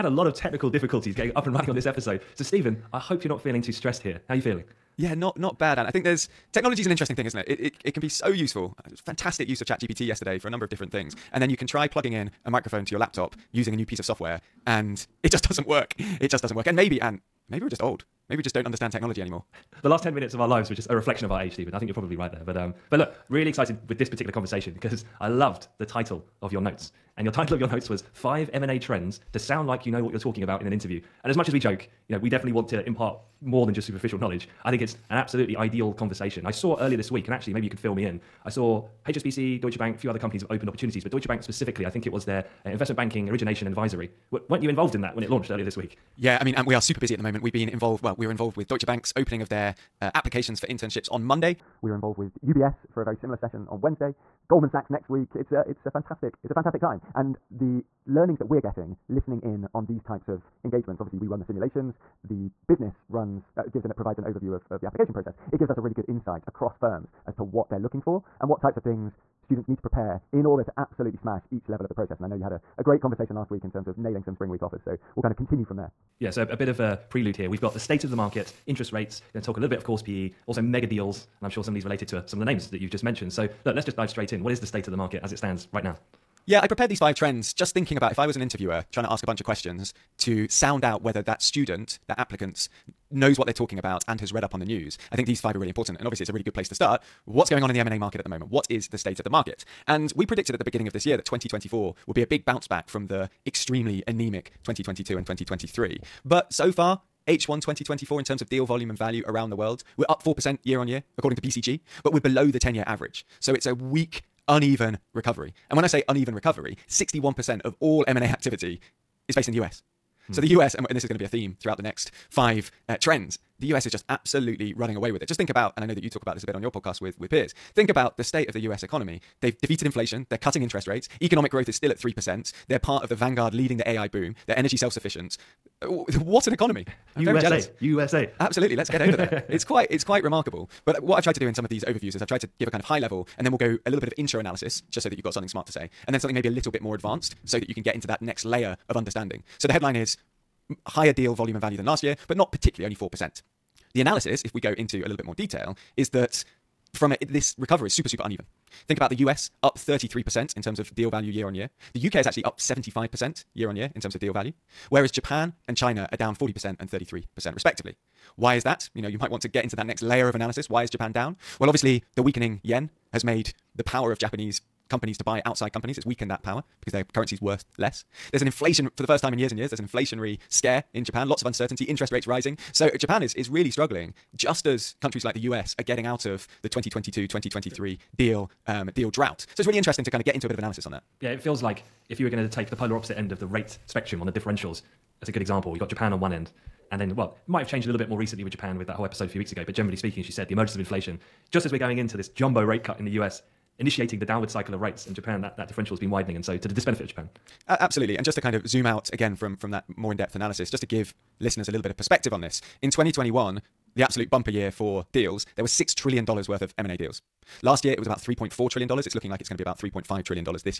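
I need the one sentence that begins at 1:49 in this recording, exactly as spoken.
We're up 4% year on year, according to BCG, but we're below the 10 year average.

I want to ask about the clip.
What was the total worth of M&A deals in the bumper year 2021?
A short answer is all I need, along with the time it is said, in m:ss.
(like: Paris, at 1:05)
$6 trillion, at 3:35.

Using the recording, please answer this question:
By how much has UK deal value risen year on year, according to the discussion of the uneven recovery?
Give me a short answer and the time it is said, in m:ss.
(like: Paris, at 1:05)
75%, at 2:42.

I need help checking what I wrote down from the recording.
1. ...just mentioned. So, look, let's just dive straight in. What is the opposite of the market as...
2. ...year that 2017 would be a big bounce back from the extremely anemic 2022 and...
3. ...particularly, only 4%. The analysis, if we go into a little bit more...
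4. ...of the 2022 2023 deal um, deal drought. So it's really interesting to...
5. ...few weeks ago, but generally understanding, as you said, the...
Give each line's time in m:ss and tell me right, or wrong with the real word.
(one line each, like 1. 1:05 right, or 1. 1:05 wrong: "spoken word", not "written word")
1. 1:22 wrong: "state", not "opposite"
2. 1:41 wrong: "2024", not "2017"
3. 2:32 right
4. 3:06 right
5. 3:19 wrong: "speaking", not "understanding".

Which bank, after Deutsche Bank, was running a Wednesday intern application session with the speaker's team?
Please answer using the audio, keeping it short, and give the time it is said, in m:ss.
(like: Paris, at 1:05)
UBS, at 0:52.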